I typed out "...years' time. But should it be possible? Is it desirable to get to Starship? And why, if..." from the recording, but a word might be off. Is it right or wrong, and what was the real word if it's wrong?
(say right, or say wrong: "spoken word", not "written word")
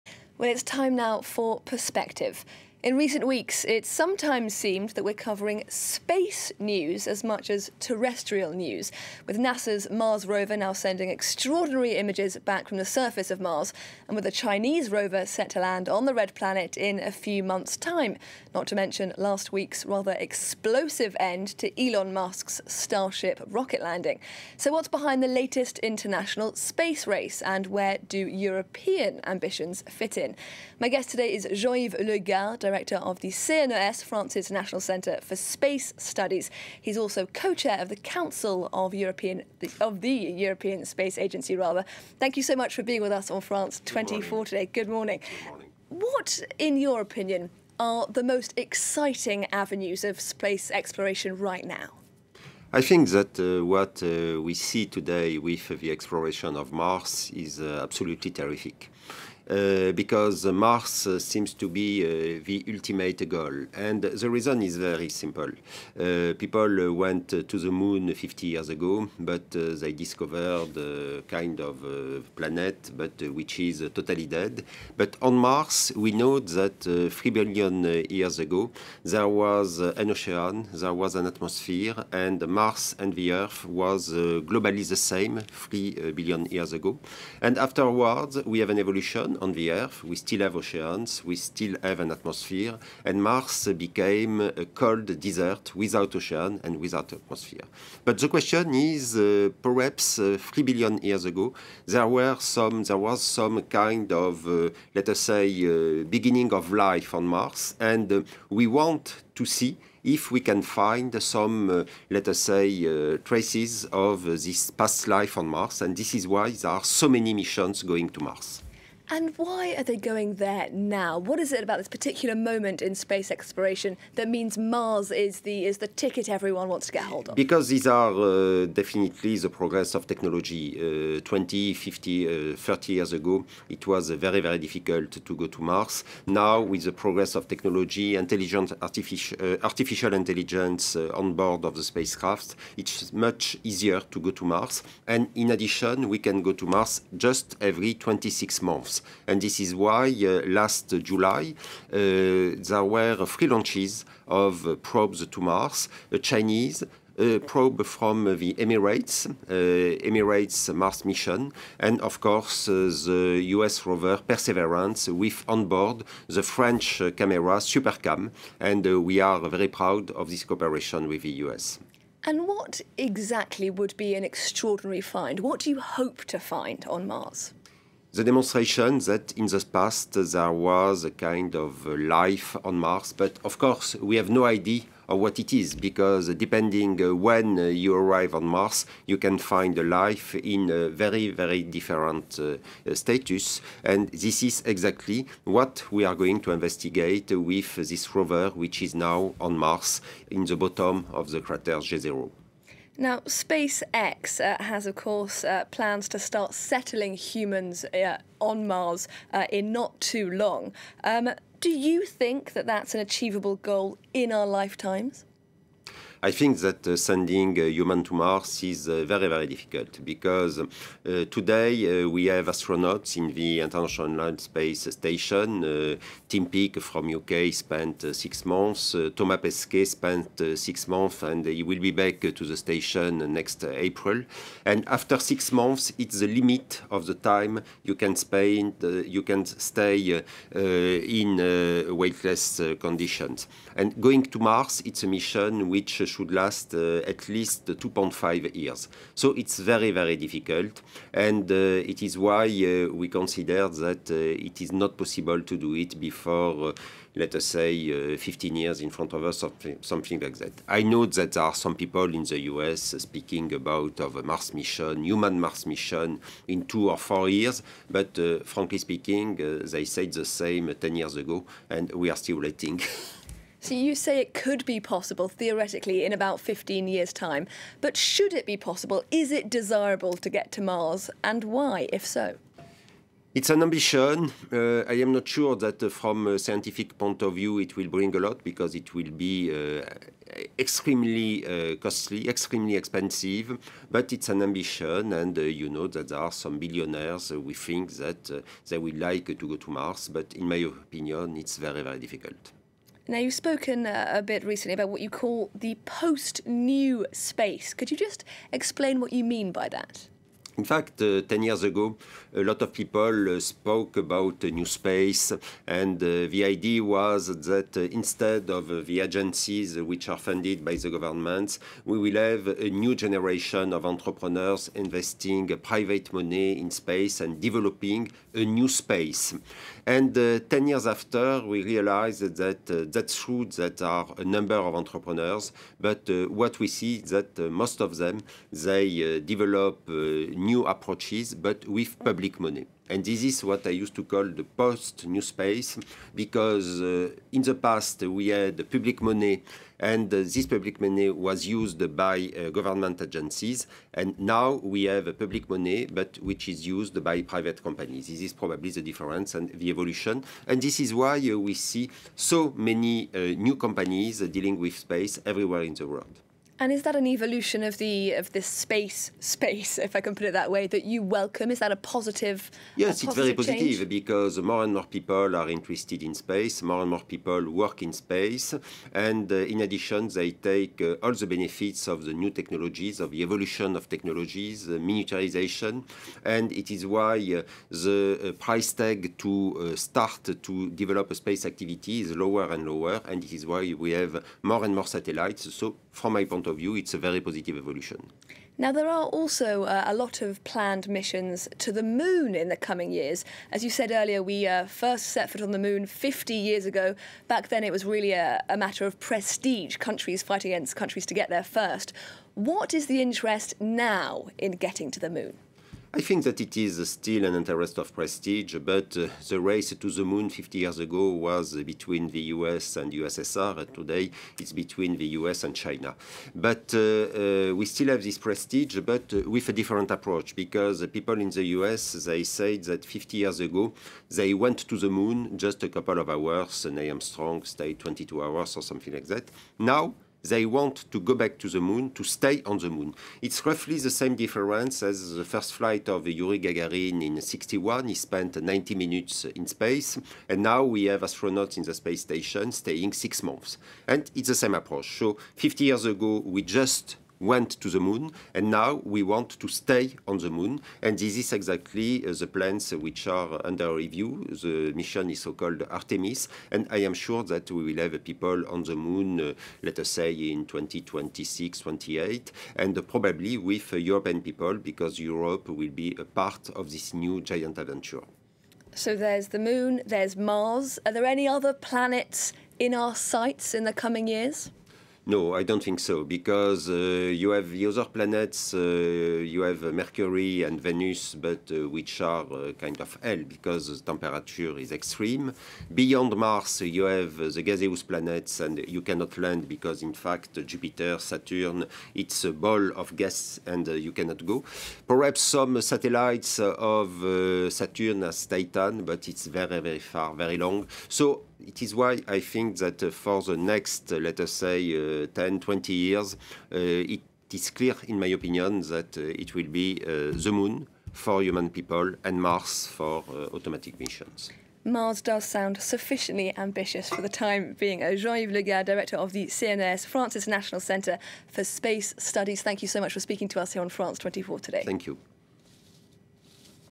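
wrong: "Mars", not "Starship".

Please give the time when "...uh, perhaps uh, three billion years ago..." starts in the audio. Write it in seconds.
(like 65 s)
99 s.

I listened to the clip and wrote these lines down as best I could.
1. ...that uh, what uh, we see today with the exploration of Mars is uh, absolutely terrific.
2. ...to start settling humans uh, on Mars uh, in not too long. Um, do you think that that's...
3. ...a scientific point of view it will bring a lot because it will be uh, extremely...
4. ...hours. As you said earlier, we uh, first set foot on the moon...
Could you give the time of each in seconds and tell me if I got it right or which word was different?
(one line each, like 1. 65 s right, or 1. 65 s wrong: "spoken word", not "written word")
1. 53 s right
2. 206 s right
3. 286 s right
4. 402 s wrong: "years", not "hours".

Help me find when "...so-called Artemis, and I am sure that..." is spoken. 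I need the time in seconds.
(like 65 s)
465 s.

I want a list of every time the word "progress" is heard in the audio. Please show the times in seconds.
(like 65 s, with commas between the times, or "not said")
129 s, 136 s.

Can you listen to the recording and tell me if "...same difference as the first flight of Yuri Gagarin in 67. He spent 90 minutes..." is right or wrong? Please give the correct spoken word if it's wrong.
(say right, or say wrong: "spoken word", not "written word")
wrong: "61", not "67".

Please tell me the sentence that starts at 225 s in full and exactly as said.
Uh, Tim Peake from UK spent six months.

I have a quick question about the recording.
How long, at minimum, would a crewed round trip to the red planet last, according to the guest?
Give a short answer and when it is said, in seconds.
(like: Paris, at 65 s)
2.5 years, at 247 s.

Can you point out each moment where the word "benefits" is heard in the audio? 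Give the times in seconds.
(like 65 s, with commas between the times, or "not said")
381 s.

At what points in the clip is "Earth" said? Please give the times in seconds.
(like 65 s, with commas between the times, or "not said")
83 s, 89 s.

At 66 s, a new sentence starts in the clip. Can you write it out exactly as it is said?
people went to the moon 50 years ago, but they discovered a kind of planet, but which is totally dead.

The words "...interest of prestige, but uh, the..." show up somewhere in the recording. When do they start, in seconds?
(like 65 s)
417 s.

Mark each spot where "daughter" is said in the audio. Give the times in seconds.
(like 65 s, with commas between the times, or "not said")
not said.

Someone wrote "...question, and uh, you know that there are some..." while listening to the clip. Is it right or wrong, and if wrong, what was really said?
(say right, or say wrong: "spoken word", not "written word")
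wrong: "ambition", not "question".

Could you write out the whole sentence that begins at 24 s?
So, what's behind the latest international space race, and where do European ambitions fit in?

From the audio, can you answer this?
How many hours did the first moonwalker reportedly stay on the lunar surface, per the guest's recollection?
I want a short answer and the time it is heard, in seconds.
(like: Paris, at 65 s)
22 hours, at 437 s.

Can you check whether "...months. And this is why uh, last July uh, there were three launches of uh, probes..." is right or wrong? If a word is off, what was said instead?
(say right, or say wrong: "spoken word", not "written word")
right.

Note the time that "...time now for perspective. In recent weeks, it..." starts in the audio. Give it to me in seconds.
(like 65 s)
0 s.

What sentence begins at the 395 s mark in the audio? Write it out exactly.
So from my point of view, it's a very positive evolution.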